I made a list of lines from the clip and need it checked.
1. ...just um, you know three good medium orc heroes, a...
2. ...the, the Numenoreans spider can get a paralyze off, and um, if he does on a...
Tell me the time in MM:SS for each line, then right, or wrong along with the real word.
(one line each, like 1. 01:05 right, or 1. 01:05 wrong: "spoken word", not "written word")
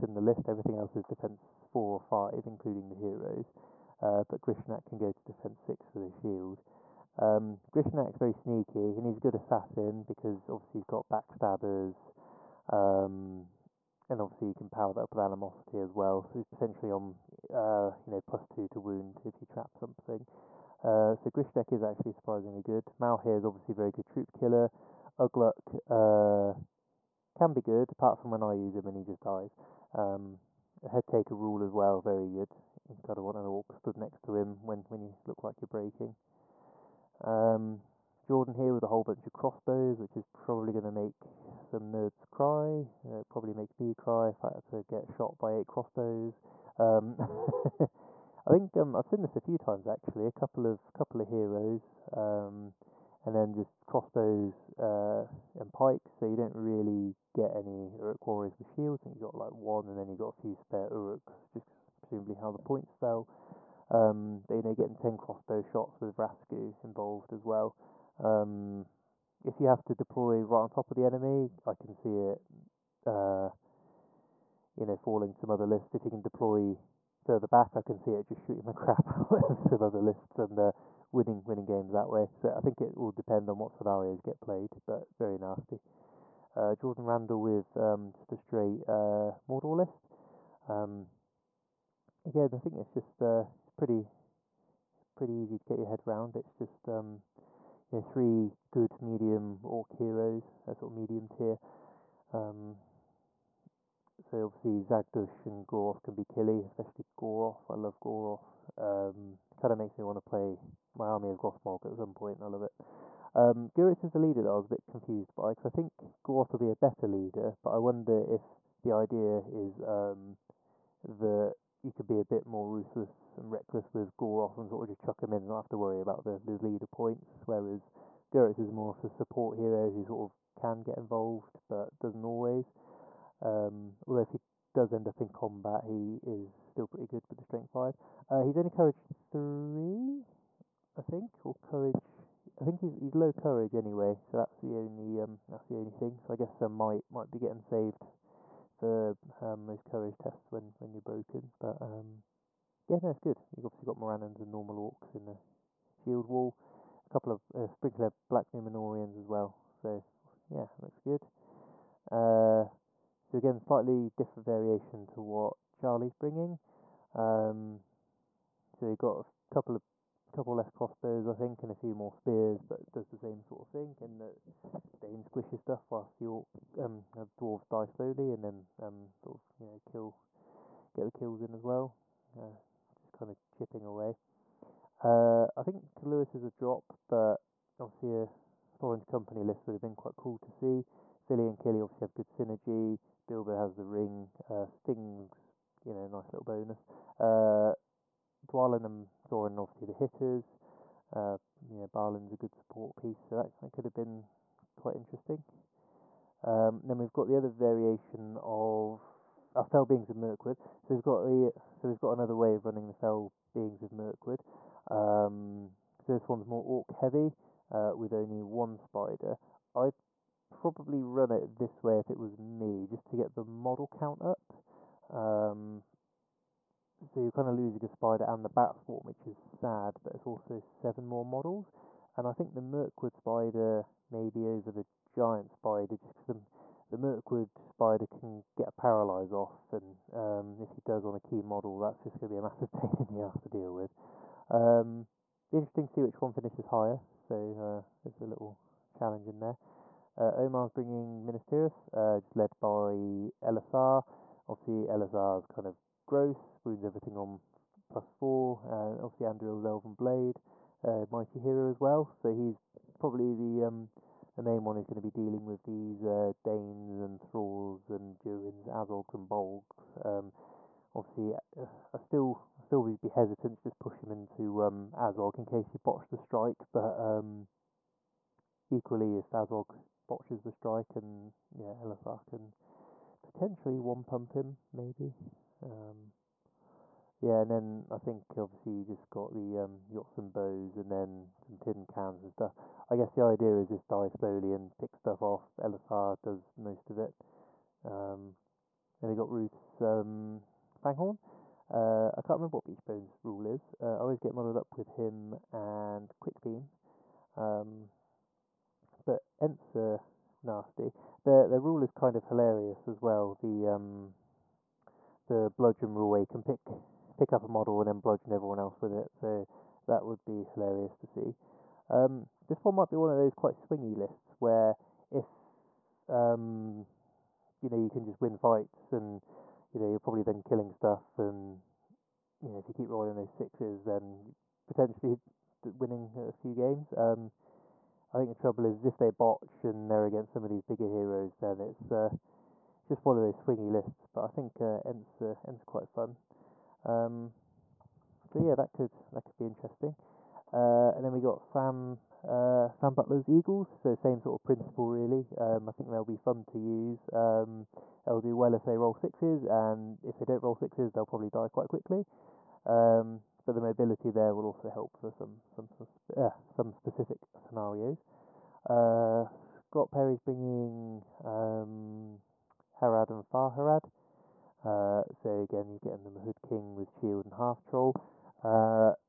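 1. 01:36 right
2. 03:56 wrong: "Mirkwood", not "Numenoreans".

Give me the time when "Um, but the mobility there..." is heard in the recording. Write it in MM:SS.
06:02.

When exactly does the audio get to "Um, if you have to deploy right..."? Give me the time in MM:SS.
01:08.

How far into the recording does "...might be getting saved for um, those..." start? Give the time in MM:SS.
02:27.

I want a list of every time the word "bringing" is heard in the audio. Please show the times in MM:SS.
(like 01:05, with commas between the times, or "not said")
02:46, 04:10, 06:10.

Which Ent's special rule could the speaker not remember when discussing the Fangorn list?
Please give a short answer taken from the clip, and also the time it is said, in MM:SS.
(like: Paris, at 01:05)
Beechbone, at 05:02.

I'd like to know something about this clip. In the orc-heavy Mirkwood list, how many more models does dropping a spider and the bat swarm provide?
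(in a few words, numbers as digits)
7.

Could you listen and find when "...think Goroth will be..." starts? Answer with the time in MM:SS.
01:55.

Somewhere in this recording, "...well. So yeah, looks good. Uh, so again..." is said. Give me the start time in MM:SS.
02:39.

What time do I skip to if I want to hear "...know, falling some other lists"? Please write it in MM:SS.
01:14.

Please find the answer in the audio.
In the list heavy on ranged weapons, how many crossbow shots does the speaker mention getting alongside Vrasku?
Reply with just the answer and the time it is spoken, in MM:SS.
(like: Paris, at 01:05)
10, at 01:04.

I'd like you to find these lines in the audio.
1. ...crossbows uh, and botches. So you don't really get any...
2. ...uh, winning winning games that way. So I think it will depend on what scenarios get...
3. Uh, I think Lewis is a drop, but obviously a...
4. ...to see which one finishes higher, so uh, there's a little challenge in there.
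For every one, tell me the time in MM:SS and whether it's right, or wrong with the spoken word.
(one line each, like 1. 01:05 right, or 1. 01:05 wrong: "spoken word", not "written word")
1. 00:53 wrong: "pikes", not "botches"
2. 01:20 right
3. 03:05 right
4. 04:05 right.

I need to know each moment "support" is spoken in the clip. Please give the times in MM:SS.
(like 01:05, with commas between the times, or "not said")
02:09, 03:22.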